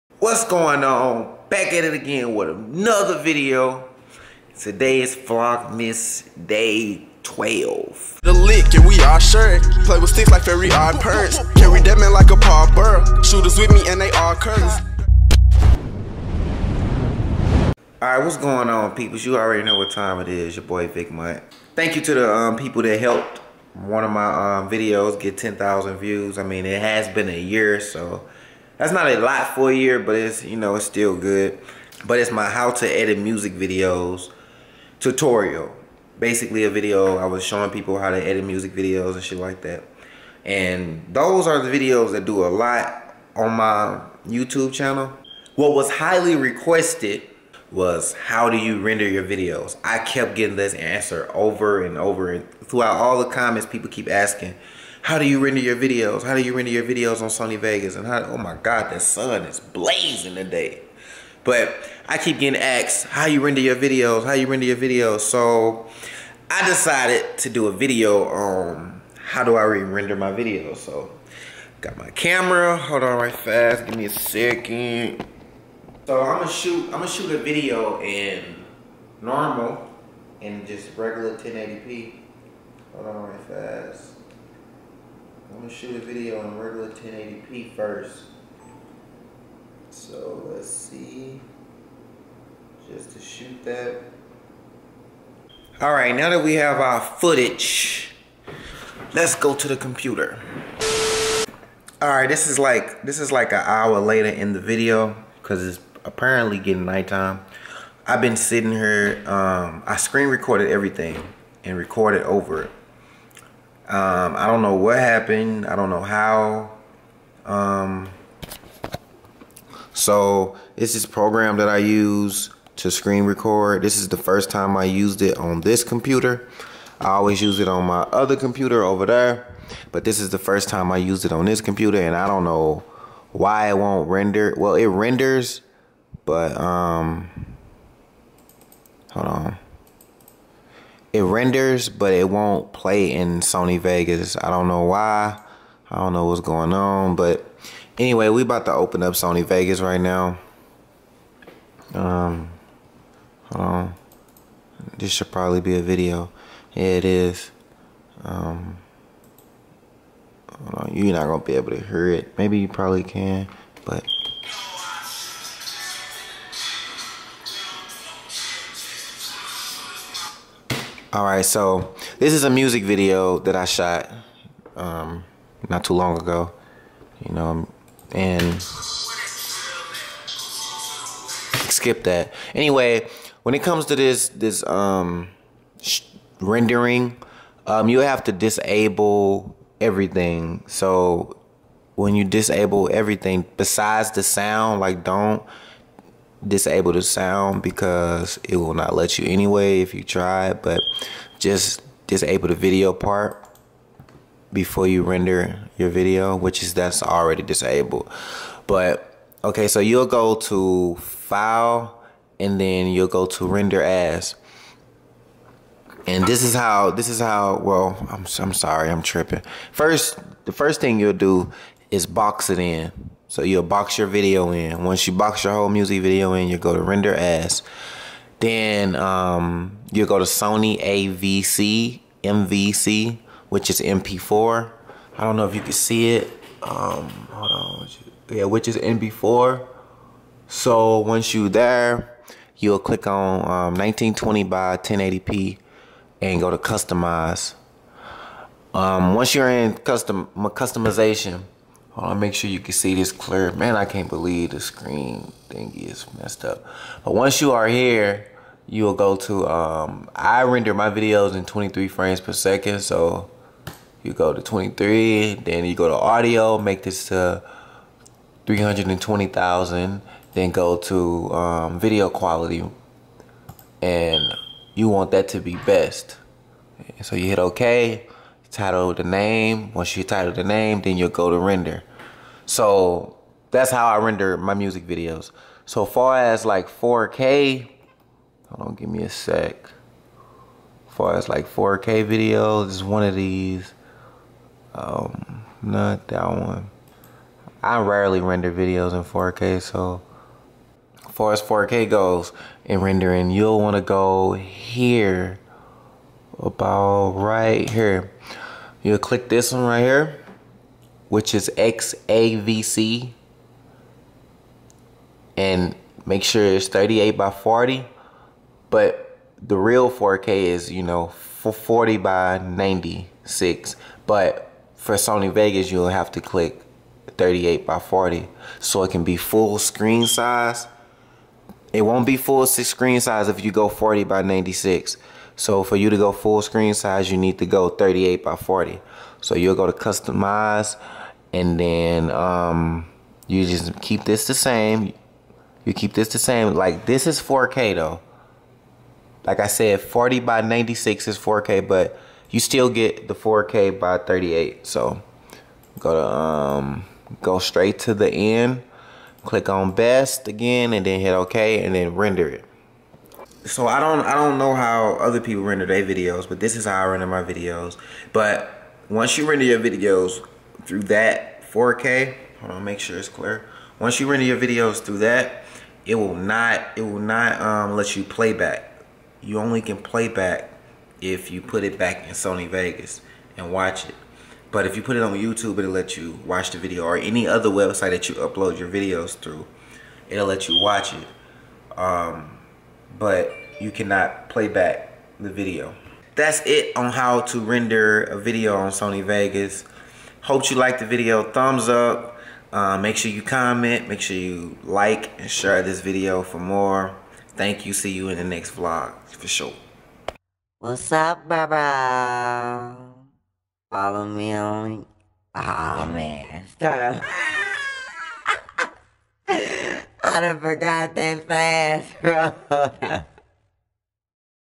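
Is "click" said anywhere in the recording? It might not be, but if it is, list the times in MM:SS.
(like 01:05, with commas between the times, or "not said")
04:02, 05:08, 05:26, 05:59.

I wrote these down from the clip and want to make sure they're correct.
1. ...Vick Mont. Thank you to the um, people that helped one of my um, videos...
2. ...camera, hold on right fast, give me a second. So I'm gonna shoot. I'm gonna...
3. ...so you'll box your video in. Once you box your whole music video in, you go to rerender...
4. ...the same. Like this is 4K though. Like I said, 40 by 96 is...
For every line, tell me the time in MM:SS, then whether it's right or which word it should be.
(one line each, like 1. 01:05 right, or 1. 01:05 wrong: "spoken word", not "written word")
1. 00:20 right
2. 01:12 right
3. 03:43 wrong: "render", not "rerender"
4. 05:46 right.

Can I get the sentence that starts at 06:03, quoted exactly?
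So I don't I don't know how other people render their videos, but this is how I render my videos.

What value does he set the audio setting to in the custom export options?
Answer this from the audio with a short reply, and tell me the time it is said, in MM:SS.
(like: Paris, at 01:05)
320,000, at 04:28.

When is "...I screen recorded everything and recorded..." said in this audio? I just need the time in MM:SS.
01:49.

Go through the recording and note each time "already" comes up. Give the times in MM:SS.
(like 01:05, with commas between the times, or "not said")
00:19, 03:27.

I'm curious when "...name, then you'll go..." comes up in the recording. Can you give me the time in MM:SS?
04:40.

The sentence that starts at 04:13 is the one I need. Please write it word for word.
Man, I can't believe the screen thing is messed up.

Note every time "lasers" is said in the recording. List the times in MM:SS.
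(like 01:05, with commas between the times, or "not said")
not said.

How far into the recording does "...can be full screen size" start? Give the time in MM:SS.
05:28.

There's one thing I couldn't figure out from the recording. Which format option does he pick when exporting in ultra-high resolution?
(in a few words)
XAVC.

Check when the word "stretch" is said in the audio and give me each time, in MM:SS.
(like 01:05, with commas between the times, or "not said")
not said.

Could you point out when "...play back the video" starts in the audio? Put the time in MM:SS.
06:34.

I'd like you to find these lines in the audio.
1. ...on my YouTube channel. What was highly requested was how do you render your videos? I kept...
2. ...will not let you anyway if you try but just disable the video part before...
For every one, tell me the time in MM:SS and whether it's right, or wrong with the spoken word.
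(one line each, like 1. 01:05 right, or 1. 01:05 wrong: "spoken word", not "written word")
1. 00:43 right
2. 03:18 right.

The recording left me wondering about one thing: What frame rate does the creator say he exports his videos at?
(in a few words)
23 frames per second.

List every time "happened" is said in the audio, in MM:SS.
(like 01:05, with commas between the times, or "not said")
01:54.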